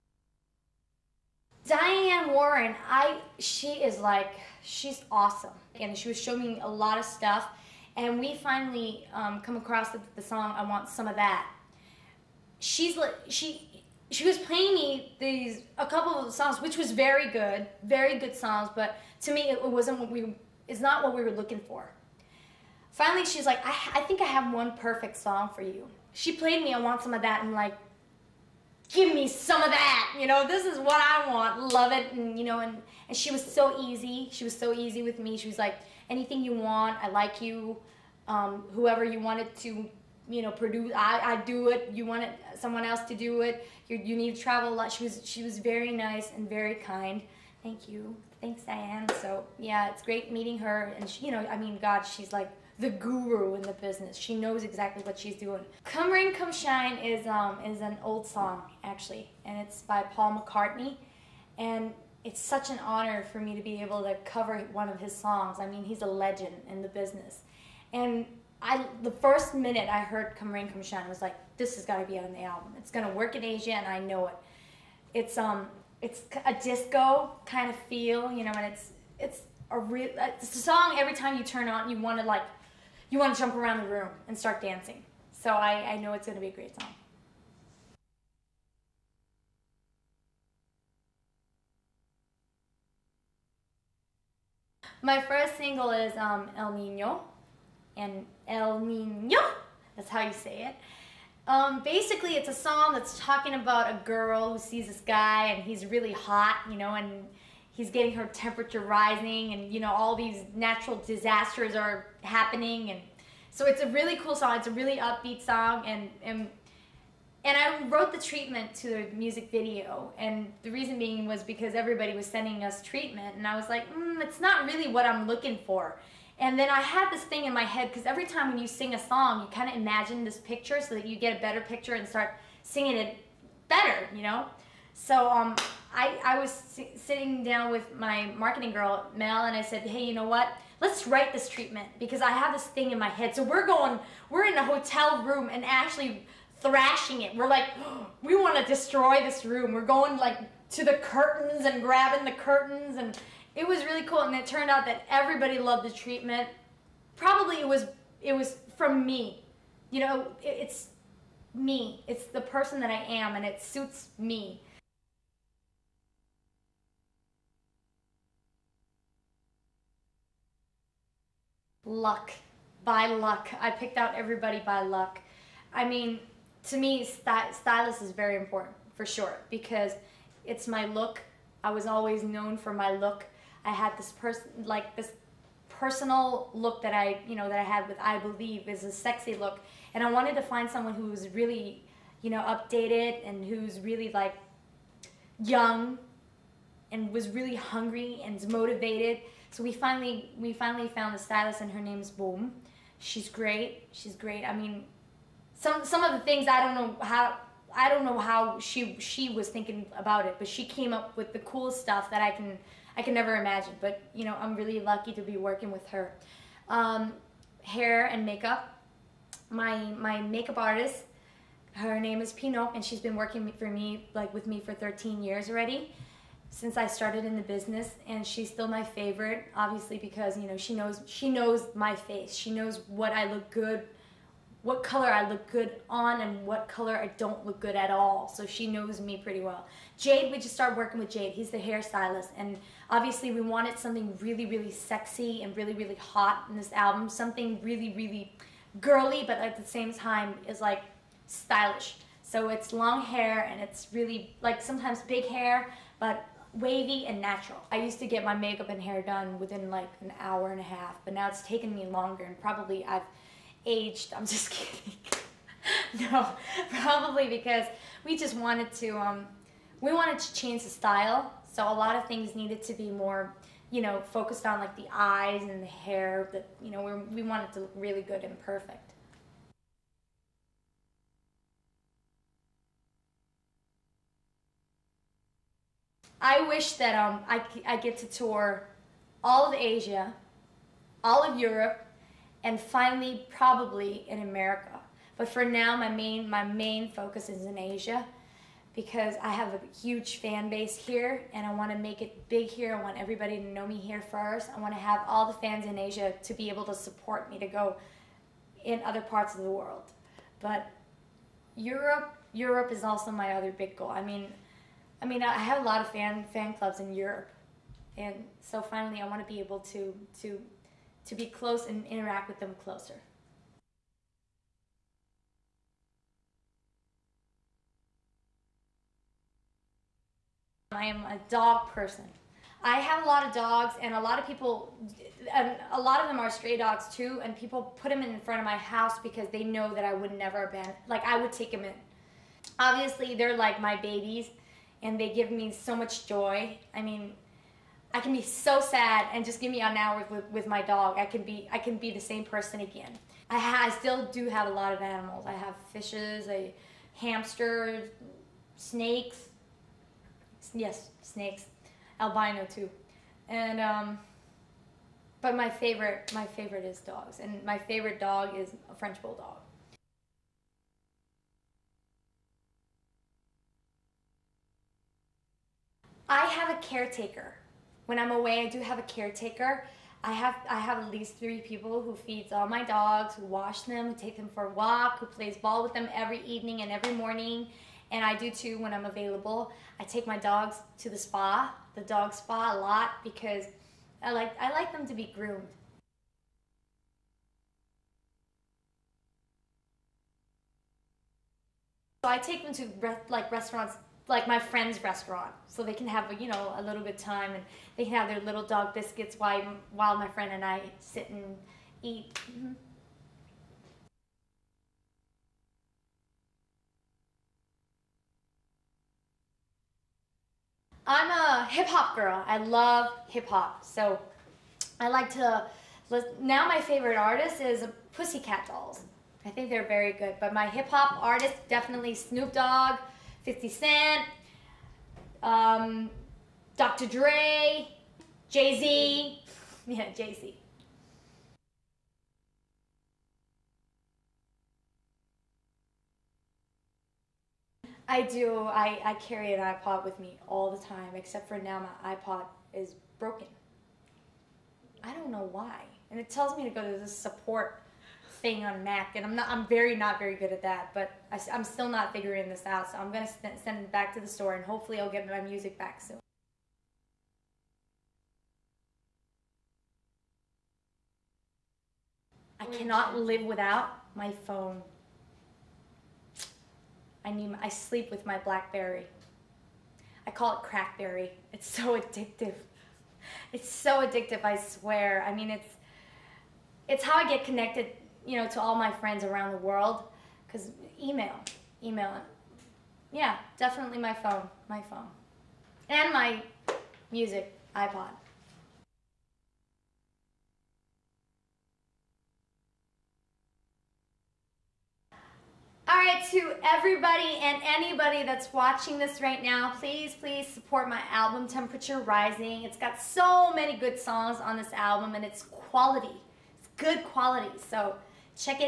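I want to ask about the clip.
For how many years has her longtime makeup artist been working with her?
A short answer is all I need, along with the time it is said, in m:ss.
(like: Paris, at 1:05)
13, at 3:44.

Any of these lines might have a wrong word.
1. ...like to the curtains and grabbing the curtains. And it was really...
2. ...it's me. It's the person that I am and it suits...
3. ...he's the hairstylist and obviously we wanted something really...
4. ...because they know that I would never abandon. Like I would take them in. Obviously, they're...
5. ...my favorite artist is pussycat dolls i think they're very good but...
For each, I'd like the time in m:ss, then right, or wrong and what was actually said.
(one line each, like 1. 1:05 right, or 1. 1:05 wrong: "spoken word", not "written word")
1. 2:30 right
2. 2:40 right
3. 4:01 right
4. 5:39 right
5. 7:06 right.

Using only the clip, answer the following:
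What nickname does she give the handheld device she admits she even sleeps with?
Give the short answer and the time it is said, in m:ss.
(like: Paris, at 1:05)
Crackberry, at 8:00.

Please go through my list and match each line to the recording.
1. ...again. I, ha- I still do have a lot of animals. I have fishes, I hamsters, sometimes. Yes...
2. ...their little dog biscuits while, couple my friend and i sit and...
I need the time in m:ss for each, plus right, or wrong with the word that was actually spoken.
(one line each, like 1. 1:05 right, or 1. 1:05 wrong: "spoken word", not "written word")
1. 5:52 wrong: "snakes", not "sometimes"
2. 6:48 wrong: "while", not "couple".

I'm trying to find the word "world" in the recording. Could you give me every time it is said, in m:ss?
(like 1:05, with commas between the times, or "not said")
5:09, 8:09.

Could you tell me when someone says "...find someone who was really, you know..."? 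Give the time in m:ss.
3:10.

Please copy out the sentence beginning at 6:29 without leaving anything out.
I take my dogs to the spa, the dog spa a lot because I like I like them to be groomed.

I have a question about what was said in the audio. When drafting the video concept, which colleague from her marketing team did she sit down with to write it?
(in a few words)
Mel.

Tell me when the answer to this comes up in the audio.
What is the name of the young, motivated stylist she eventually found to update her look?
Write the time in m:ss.
3:22.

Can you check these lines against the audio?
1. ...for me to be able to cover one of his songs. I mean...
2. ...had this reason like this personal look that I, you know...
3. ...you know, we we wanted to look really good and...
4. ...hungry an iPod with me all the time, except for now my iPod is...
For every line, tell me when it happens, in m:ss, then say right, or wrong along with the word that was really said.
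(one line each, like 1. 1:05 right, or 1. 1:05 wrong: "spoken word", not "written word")
1. 1:03 right
2. 3:03 wrong: "person", not "reason"
3. 4:36 right
4. 7:28 wrong: "carry", not "hungry".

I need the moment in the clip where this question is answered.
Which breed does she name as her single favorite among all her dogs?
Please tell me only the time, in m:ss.
6:08.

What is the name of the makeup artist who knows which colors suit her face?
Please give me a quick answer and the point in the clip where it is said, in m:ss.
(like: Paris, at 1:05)
Pino, at 3:42.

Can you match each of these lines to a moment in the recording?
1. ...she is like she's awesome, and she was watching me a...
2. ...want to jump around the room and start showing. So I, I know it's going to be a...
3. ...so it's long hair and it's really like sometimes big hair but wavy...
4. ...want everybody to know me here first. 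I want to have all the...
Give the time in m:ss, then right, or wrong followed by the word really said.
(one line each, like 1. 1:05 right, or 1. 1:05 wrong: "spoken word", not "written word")
1. 0:03 wrong: "showing", not "watching"
2. 1:23 wrong: "dancing", not "showing"
3. 4:12 right
4. 5:02 right.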